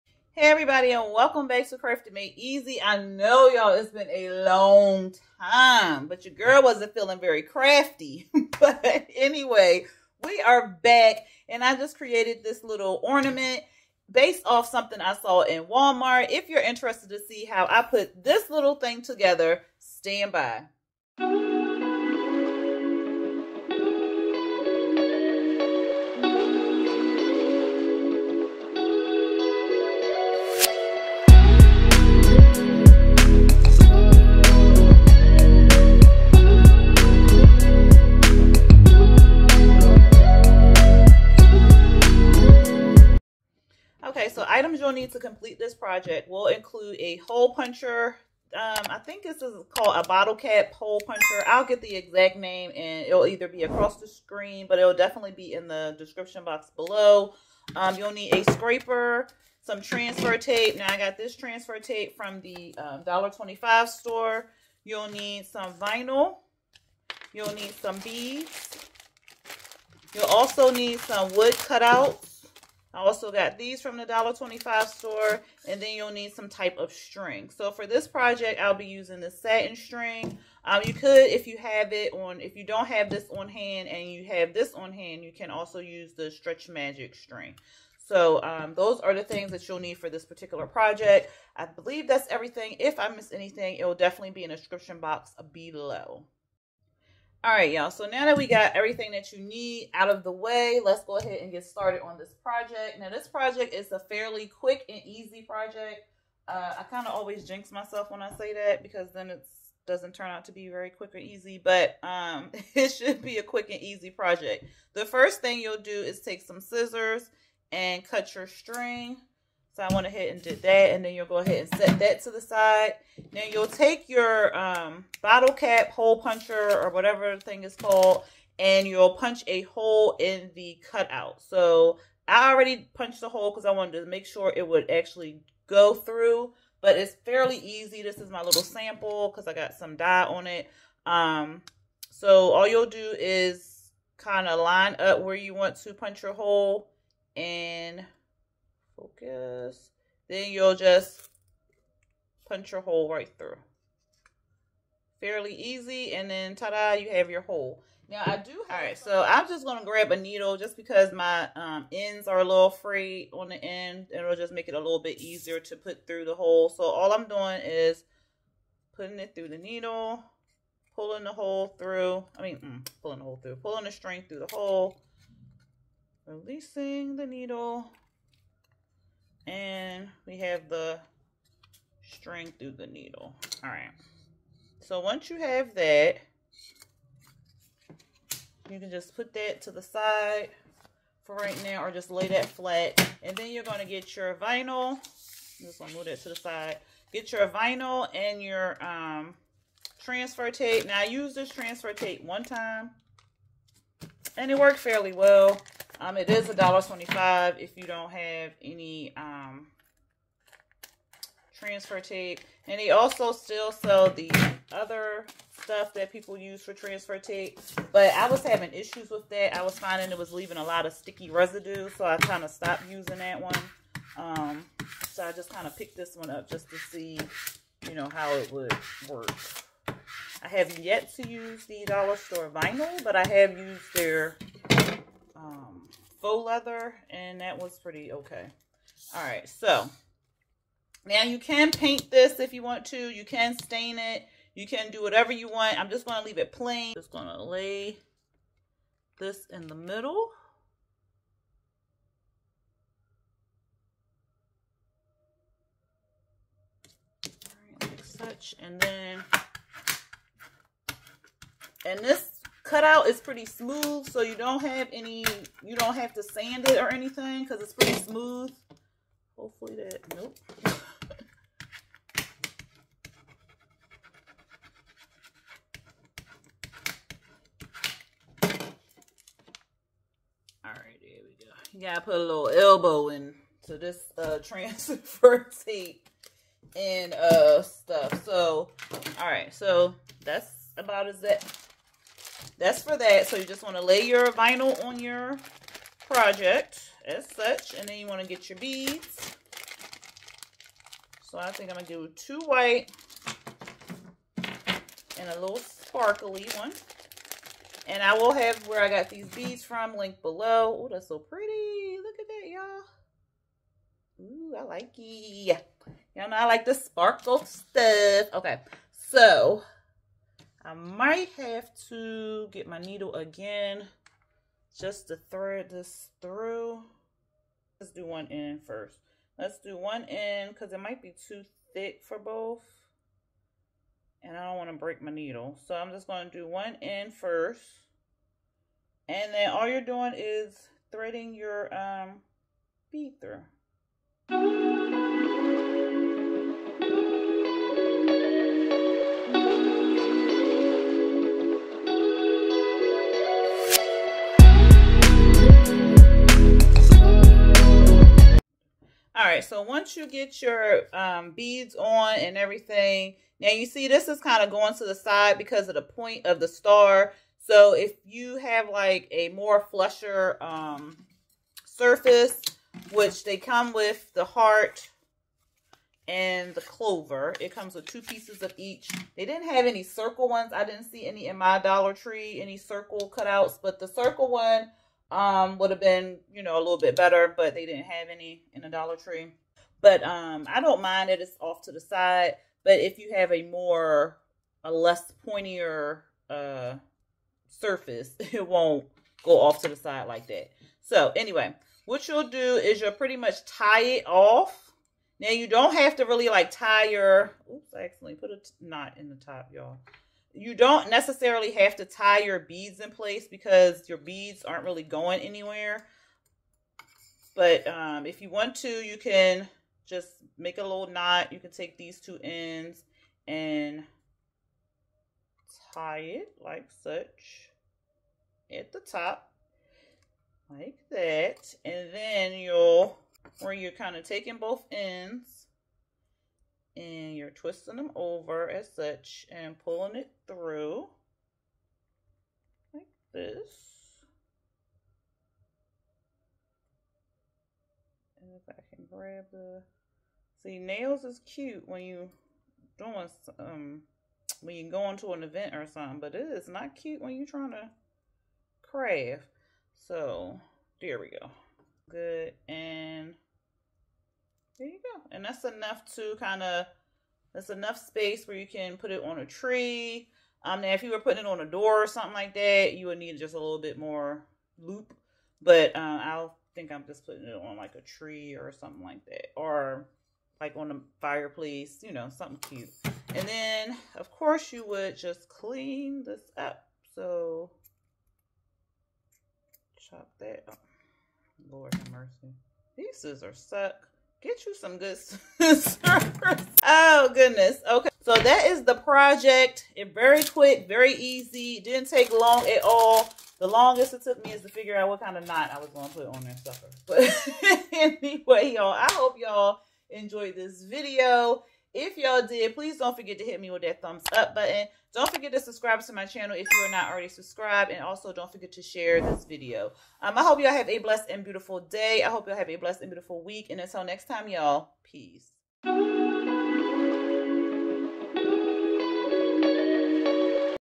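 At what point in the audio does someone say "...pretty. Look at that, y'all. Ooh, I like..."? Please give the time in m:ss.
5:11.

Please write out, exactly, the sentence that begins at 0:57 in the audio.
Um, you'll need a scraper, some transfer tape.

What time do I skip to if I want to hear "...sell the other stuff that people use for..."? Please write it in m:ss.
3:33.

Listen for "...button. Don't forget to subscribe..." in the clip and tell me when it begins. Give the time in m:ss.
8:34.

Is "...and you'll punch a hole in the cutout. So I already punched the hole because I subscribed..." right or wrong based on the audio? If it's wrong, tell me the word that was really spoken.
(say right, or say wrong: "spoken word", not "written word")
wrong: "wanted", not "subscribed".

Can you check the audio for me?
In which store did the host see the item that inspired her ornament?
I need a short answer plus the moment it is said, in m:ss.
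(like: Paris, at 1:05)
Walmart, at 0:15.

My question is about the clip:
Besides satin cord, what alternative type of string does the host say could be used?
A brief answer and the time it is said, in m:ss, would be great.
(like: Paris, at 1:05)
Stretch Magic, at 1:26.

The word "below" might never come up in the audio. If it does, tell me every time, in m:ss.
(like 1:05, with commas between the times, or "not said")
0:56, 1:35, 5:10.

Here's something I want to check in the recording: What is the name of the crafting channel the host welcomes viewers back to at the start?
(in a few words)
Crafting Made Easy.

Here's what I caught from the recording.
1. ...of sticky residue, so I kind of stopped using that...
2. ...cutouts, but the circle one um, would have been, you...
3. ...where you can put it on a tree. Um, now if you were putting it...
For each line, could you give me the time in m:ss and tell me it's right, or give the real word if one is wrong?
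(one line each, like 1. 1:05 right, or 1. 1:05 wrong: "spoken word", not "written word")
1. 3:40 right
2. 6:23 right
3. 7:48 right.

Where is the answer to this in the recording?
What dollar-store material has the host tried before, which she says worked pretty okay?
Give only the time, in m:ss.
3:56.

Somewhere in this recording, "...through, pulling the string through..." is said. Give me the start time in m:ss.
2:53.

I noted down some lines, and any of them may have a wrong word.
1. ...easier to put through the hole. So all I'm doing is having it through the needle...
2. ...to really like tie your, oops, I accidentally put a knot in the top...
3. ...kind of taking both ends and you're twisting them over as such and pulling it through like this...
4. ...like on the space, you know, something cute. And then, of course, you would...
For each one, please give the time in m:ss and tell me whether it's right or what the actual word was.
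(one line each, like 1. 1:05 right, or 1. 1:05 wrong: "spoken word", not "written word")
1. 2:45 wrong: "putting", not "having"
2. 6:45 right
3. 7:13 right
4. 8:00 wrong: "fireplace", not "space".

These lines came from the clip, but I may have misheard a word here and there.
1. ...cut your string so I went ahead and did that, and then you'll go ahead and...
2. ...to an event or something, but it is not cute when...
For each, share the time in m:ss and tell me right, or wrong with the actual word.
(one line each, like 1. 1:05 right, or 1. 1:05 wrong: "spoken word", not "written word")
1. 1:58 right
2. 7:34 right.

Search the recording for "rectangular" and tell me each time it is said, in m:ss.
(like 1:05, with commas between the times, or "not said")
not said.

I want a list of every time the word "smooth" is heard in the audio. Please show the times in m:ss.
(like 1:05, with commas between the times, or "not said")
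4:23, 4:27.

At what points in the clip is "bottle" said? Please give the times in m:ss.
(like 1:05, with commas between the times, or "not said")
0:50, 2:05.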